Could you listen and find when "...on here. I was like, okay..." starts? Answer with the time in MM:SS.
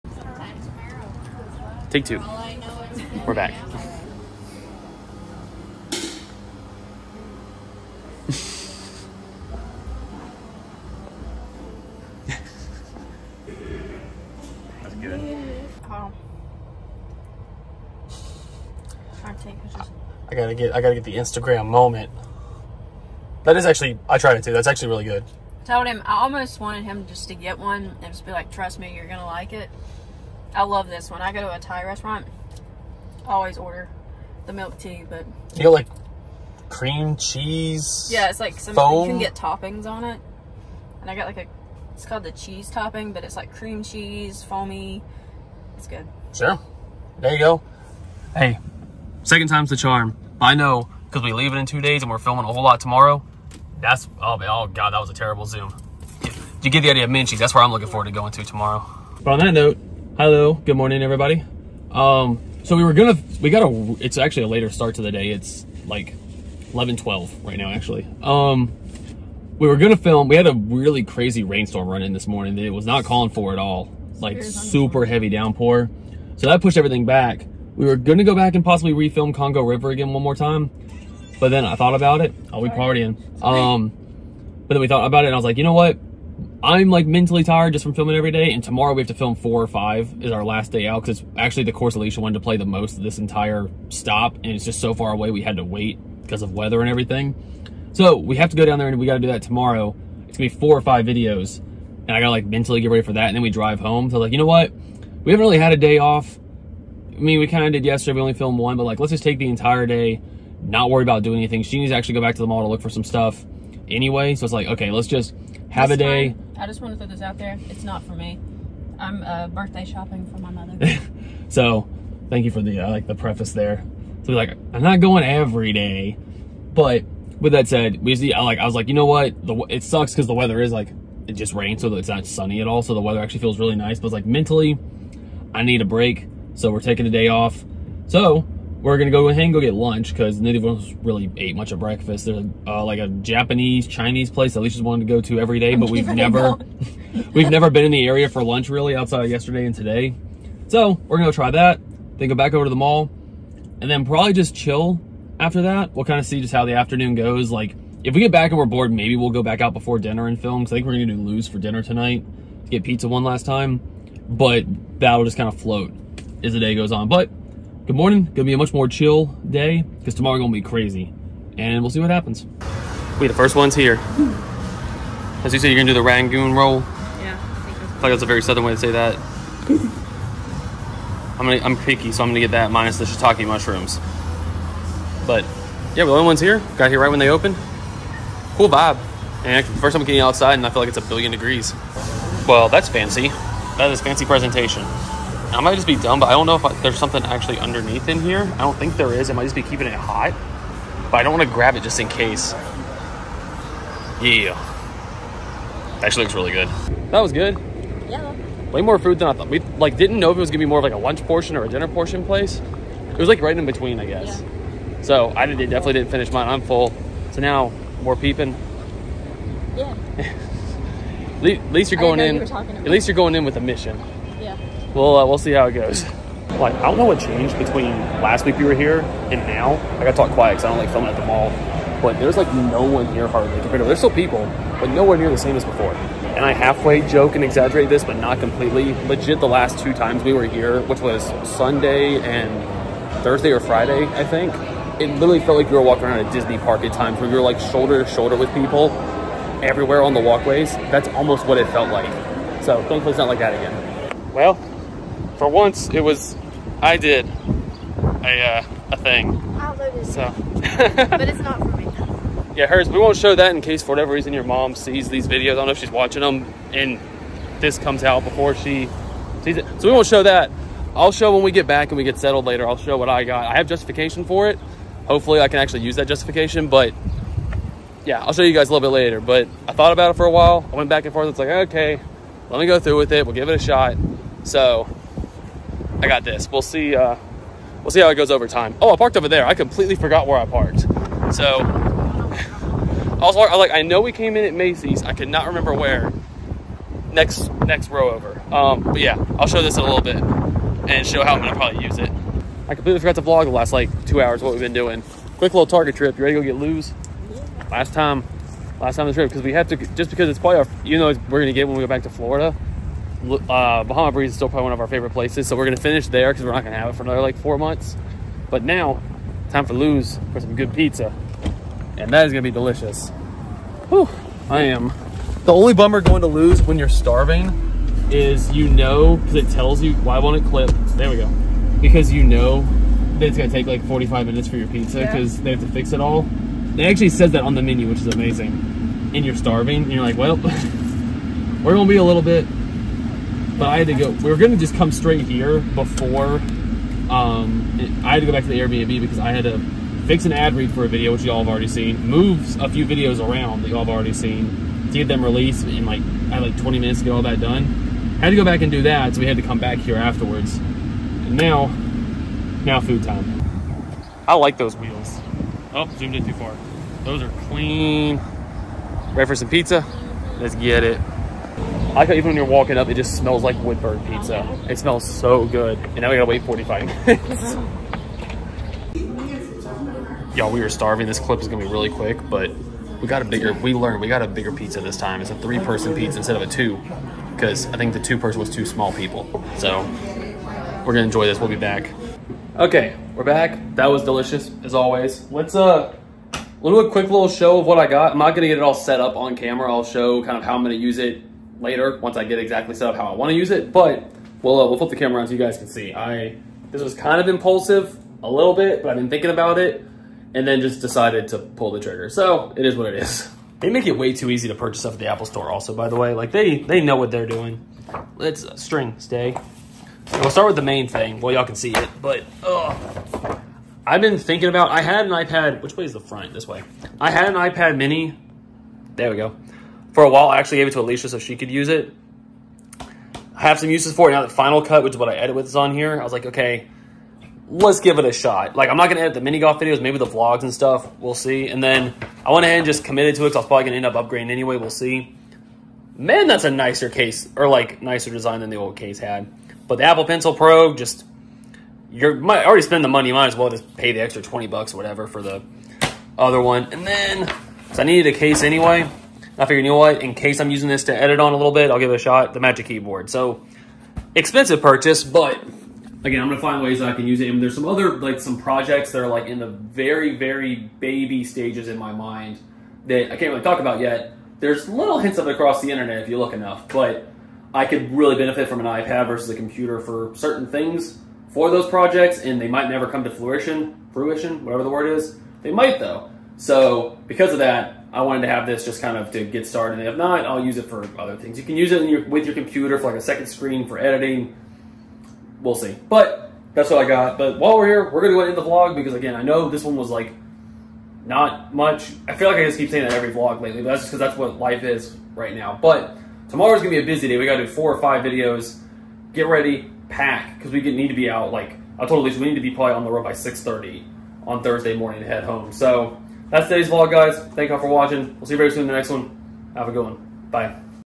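07:15.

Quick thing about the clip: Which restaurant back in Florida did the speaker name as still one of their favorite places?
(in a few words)
Bahama Breeze.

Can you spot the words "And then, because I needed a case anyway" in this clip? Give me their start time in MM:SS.
07:36.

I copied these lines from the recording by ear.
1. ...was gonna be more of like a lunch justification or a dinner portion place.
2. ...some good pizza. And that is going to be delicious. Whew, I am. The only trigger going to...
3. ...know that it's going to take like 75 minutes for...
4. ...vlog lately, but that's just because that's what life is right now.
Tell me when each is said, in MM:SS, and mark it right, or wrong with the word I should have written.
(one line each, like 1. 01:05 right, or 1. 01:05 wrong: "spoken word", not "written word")
1. 03:30 wrong: "portion", not "justification"
2. 05:20 wrong: "bummer", not "trigger"
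3. 05:32 wrong: "45", not "75"
4. 08:23 right.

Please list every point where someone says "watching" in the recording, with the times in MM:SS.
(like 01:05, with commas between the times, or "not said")
04:25, 08:37.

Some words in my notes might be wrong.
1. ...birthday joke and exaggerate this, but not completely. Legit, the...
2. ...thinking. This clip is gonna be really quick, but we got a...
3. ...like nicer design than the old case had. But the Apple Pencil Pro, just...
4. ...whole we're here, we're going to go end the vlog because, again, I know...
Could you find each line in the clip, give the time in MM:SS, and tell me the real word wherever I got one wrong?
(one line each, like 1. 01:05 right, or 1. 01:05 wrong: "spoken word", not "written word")
1. 03:56 wrong: "halfway", not "birthday"
2. 06:20 wrong: "starving", not "thinking"
3. 07:27 right
4. 08:17 wrong: "while", not "whole".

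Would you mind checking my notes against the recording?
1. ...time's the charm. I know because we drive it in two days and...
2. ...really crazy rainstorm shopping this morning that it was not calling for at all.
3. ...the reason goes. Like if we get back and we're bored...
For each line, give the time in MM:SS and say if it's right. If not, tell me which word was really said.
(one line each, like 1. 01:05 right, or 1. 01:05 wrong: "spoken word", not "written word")
1. 00:49 wrong: "leave", not "drive"
2. 01:10 wrong: "running", not "shopping"
3. 02:36 wrong: "afternoon", not "reason".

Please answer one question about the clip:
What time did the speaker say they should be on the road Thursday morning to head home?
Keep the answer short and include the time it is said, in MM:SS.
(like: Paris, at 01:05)
6:30, at 08:33.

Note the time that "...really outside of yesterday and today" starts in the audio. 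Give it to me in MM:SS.
02:28.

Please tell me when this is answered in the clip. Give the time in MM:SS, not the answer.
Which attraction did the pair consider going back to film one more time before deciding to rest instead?
01:19.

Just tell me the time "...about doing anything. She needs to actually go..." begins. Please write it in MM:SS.
01:51.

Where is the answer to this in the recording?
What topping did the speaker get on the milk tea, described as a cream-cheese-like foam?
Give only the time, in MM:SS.
00:41.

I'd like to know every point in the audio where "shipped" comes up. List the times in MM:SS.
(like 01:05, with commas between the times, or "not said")
not said.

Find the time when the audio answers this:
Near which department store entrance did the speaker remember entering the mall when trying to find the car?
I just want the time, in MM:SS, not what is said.
04:54.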